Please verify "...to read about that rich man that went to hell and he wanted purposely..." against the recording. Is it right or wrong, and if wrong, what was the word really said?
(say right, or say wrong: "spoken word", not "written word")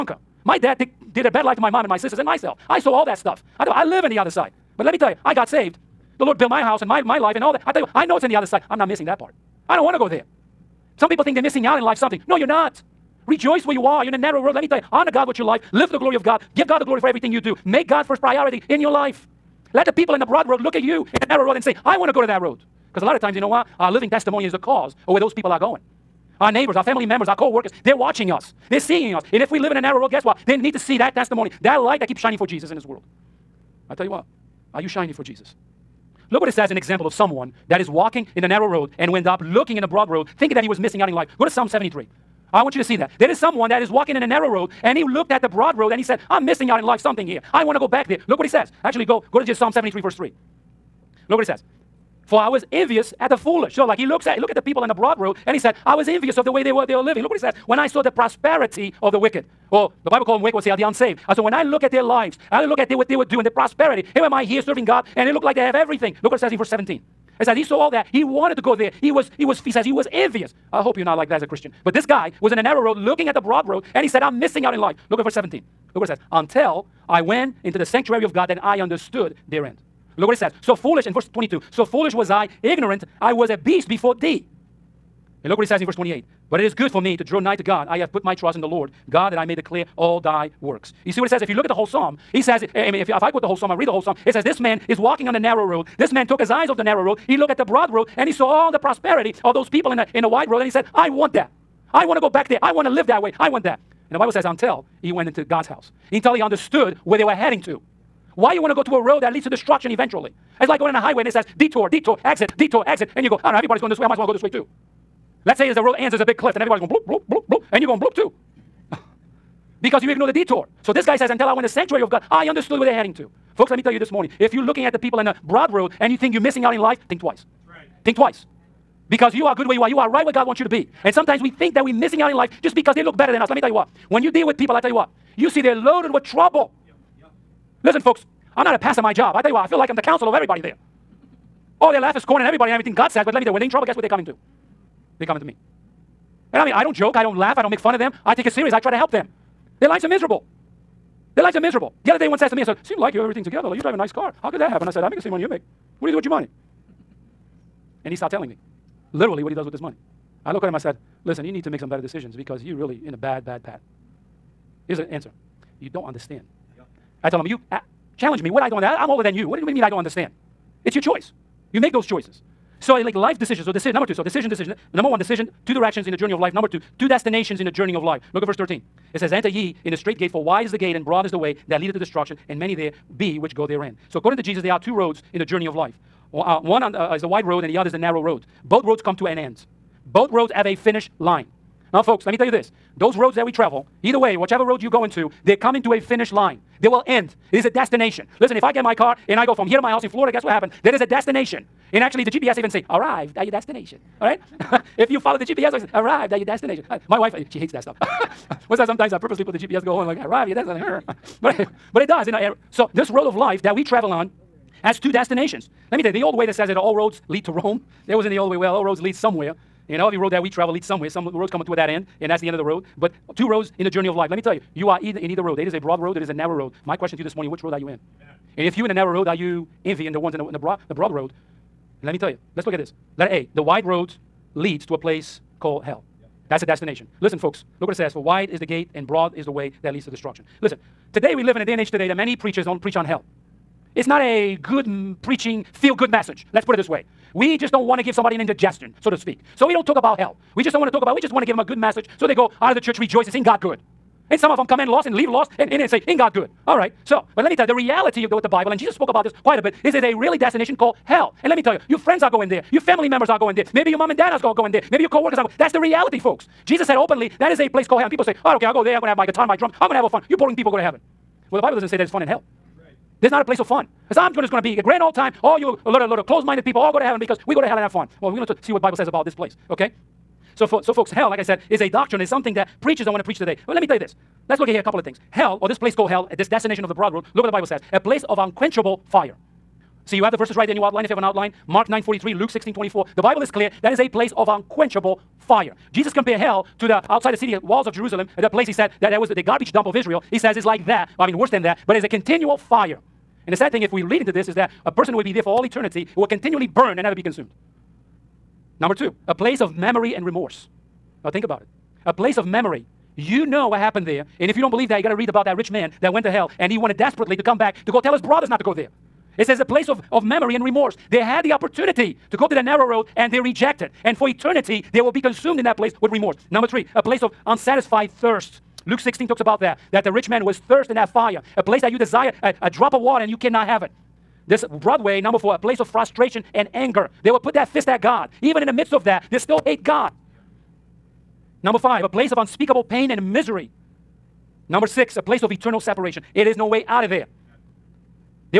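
wrong: "desperately", not "purposely".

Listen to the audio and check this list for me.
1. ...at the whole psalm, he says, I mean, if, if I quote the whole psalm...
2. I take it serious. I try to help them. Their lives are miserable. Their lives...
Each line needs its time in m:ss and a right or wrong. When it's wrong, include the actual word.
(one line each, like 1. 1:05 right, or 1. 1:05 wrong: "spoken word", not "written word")
1. 1:31 right
2. 2:28 right.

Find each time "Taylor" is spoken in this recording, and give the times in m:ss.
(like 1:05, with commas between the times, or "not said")
not said.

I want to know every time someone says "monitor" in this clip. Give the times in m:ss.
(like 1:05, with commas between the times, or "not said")
not said.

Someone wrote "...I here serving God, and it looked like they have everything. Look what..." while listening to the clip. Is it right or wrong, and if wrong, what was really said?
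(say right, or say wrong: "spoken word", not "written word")
right.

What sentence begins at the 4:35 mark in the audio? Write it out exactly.
All you a lot of, lot of closed-minded people all go to heaven because we go to hell and have fun.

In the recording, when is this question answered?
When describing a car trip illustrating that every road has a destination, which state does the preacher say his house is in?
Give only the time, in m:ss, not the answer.
3:20.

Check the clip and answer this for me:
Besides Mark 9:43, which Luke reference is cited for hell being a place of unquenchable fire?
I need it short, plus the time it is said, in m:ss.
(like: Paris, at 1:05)
Luke 16:24, at 4:52.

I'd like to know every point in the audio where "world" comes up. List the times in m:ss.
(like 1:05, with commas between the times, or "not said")
0:32, 4:47.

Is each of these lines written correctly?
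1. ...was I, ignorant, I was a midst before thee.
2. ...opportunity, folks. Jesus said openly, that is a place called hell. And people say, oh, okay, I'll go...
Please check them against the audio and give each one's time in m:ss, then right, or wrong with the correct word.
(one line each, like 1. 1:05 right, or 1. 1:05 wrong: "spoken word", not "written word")
1. 1:22 wrong: "beast", not "midst"
2. 4:25 wrong: "reality", not "opportunity".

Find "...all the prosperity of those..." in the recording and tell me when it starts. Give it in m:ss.
1:38.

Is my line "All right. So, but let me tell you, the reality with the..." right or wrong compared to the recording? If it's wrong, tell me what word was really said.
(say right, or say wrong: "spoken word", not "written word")
right.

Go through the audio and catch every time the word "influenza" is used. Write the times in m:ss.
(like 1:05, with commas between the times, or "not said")
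not said.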